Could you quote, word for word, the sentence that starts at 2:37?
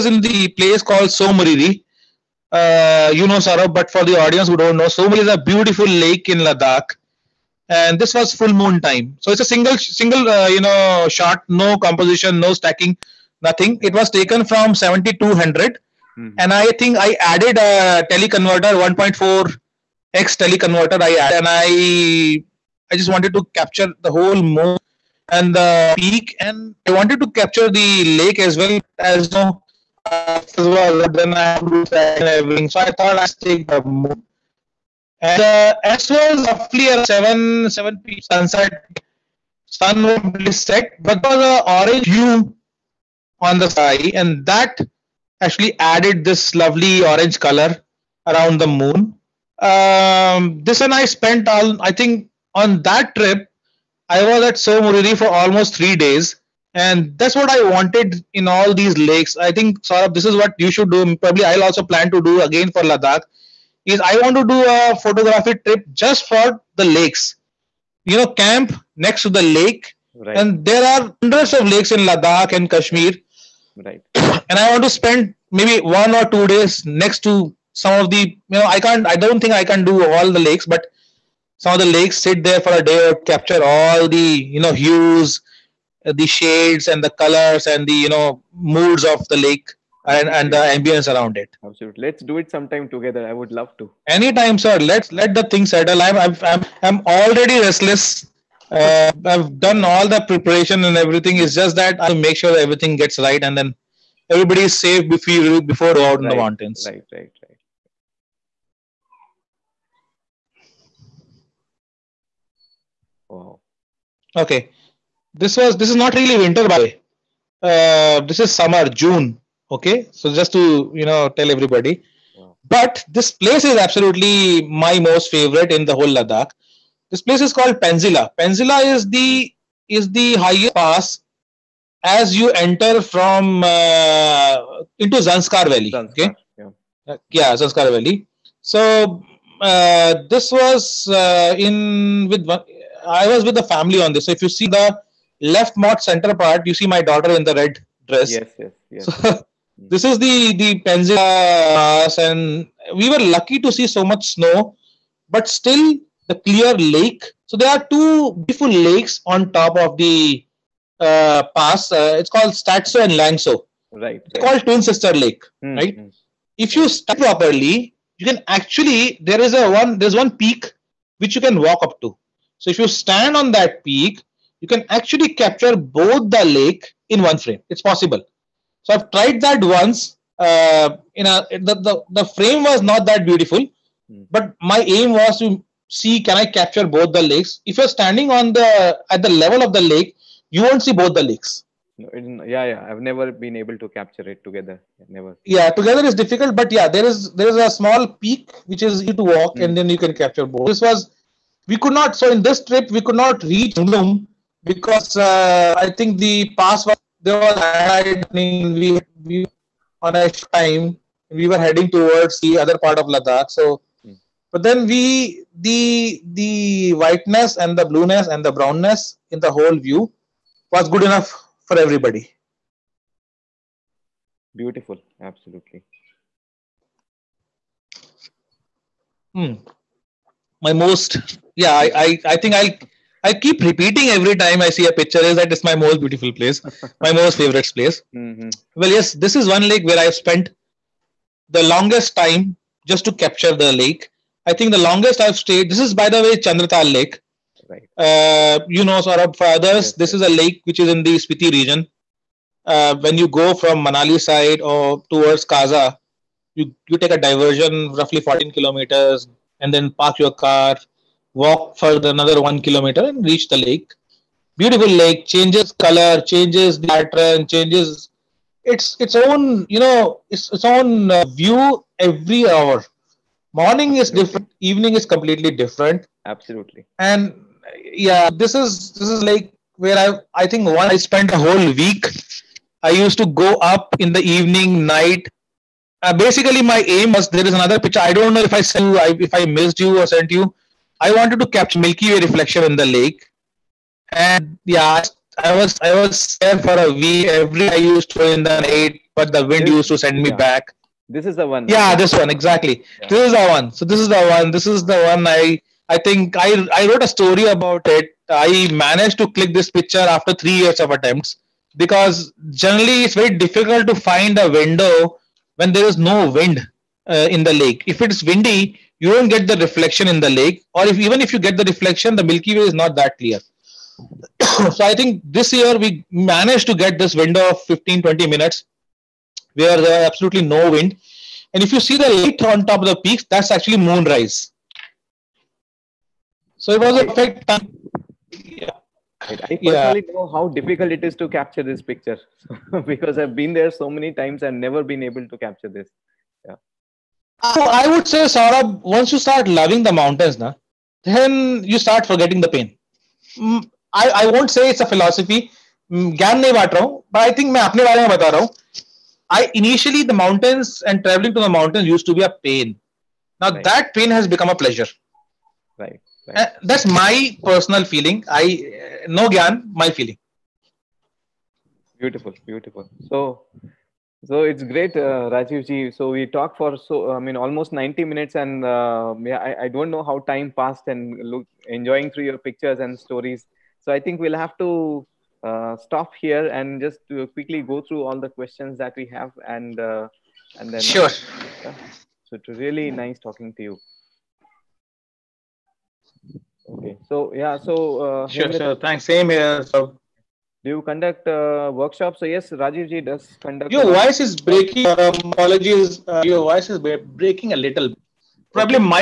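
So there are two beautiful lakes on top of the uh, pass.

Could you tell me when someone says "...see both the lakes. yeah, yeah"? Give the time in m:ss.
3:10.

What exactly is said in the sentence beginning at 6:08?
I uh, no Gyan, my feeling.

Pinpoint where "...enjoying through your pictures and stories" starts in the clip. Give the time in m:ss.
6:21.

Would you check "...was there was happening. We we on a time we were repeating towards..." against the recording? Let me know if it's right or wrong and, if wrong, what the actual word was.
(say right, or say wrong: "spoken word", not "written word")
wrong: "heading", not "repeating".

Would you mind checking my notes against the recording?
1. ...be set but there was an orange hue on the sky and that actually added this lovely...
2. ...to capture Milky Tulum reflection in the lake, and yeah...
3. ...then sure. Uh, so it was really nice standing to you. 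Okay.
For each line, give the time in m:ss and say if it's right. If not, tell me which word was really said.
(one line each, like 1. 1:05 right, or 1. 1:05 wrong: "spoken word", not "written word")
1. 0:40 right
2. 4:51 wrong: "Way", not "Tulum"
3. 6:30 wrong: "talking", not "standing".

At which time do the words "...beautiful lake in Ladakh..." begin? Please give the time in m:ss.
0:05.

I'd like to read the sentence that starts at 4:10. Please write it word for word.
is a lake which is in the Spiti region.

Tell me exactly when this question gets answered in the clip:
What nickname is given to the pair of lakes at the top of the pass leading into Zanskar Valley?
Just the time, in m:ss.
2:44.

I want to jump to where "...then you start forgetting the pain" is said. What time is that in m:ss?
5:51.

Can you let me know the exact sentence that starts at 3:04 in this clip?
but my aim was to see can I capture both the lakes.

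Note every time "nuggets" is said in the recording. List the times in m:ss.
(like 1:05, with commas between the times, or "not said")
not said.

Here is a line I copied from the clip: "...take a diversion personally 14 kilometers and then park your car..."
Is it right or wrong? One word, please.
wrong.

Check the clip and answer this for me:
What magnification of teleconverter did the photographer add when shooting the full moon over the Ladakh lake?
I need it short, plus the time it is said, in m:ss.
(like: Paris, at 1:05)
1.4x, at 0:18.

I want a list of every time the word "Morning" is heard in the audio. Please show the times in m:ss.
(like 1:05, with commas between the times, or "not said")
4:33.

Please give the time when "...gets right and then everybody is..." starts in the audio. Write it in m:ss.
1:43.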